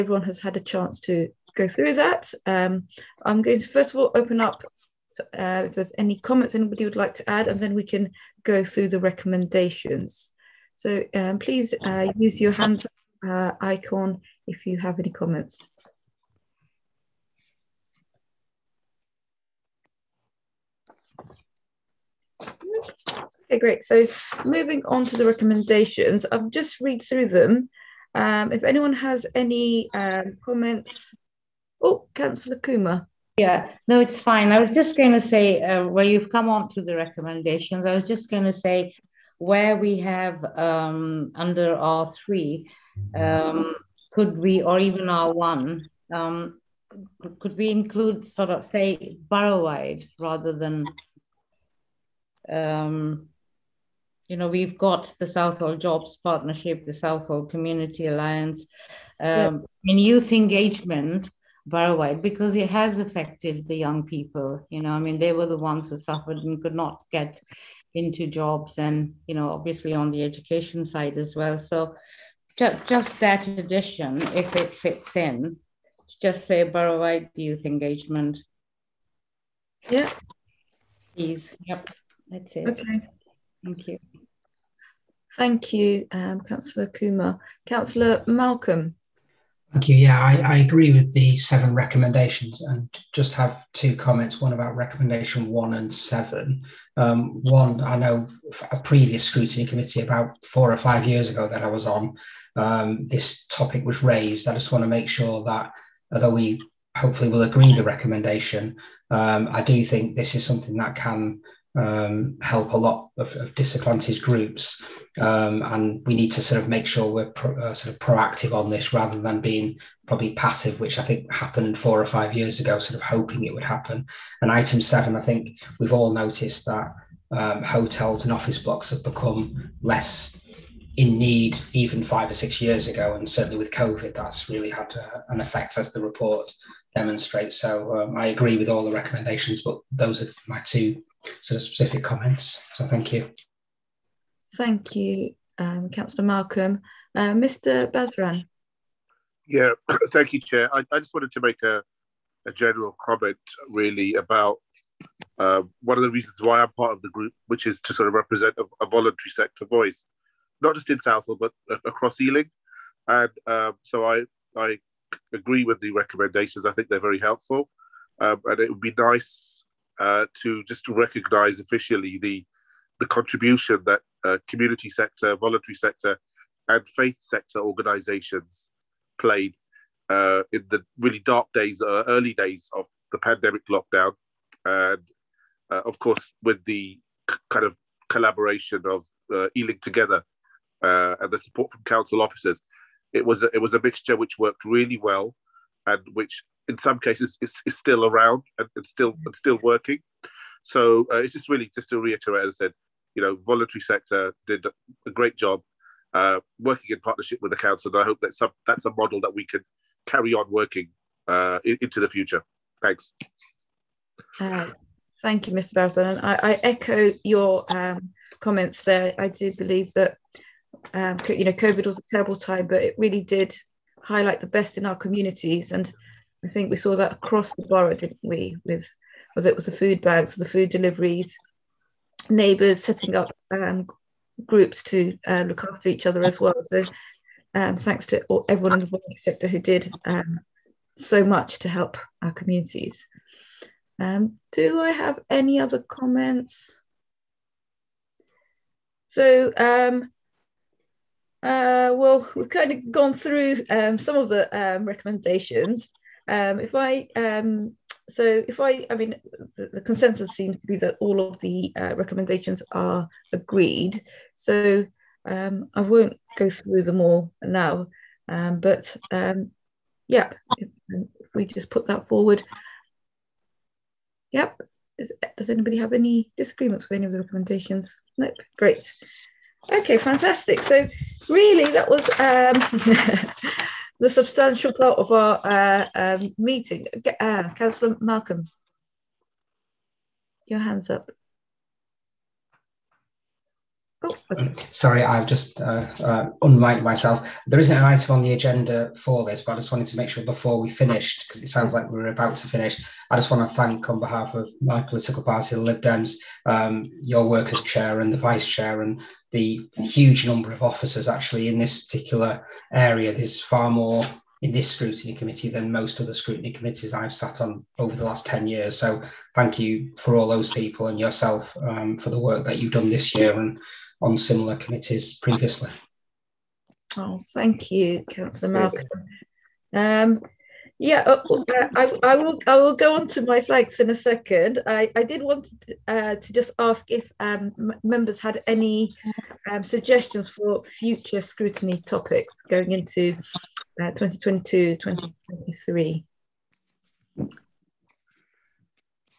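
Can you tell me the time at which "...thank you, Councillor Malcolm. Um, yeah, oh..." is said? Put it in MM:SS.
05:27.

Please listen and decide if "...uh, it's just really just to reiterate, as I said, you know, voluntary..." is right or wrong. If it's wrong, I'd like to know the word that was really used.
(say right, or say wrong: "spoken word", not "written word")
right.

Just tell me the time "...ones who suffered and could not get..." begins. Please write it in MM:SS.
01:05.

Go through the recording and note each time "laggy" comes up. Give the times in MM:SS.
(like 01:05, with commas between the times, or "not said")
not said.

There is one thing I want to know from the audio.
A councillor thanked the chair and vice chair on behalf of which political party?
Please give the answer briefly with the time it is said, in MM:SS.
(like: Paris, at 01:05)
the Lib Dems, at 05:05.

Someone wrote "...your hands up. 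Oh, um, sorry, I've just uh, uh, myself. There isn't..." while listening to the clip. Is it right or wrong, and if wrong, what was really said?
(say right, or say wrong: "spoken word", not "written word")
right.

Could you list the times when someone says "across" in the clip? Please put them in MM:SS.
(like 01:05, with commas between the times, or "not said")
02:41, 03:47.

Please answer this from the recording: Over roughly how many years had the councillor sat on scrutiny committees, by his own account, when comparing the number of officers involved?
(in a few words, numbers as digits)
10.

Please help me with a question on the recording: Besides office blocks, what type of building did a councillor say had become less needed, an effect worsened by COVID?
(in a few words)
hotels.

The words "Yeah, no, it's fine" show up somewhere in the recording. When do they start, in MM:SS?
00:33.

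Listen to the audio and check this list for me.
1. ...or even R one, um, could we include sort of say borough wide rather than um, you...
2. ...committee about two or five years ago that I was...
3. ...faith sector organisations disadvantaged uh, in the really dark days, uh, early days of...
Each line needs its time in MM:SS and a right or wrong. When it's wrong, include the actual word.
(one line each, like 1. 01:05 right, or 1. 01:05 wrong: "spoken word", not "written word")
1. 00:44 right
2. 01:39 wrong: "four", not "two"
3. 02:56 wrong: "played", not "disadvantaged".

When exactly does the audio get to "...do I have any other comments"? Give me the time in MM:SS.
04:04.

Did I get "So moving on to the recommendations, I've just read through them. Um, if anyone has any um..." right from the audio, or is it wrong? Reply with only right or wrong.
right.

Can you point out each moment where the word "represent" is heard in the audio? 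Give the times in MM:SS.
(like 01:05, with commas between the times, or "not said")
02:38.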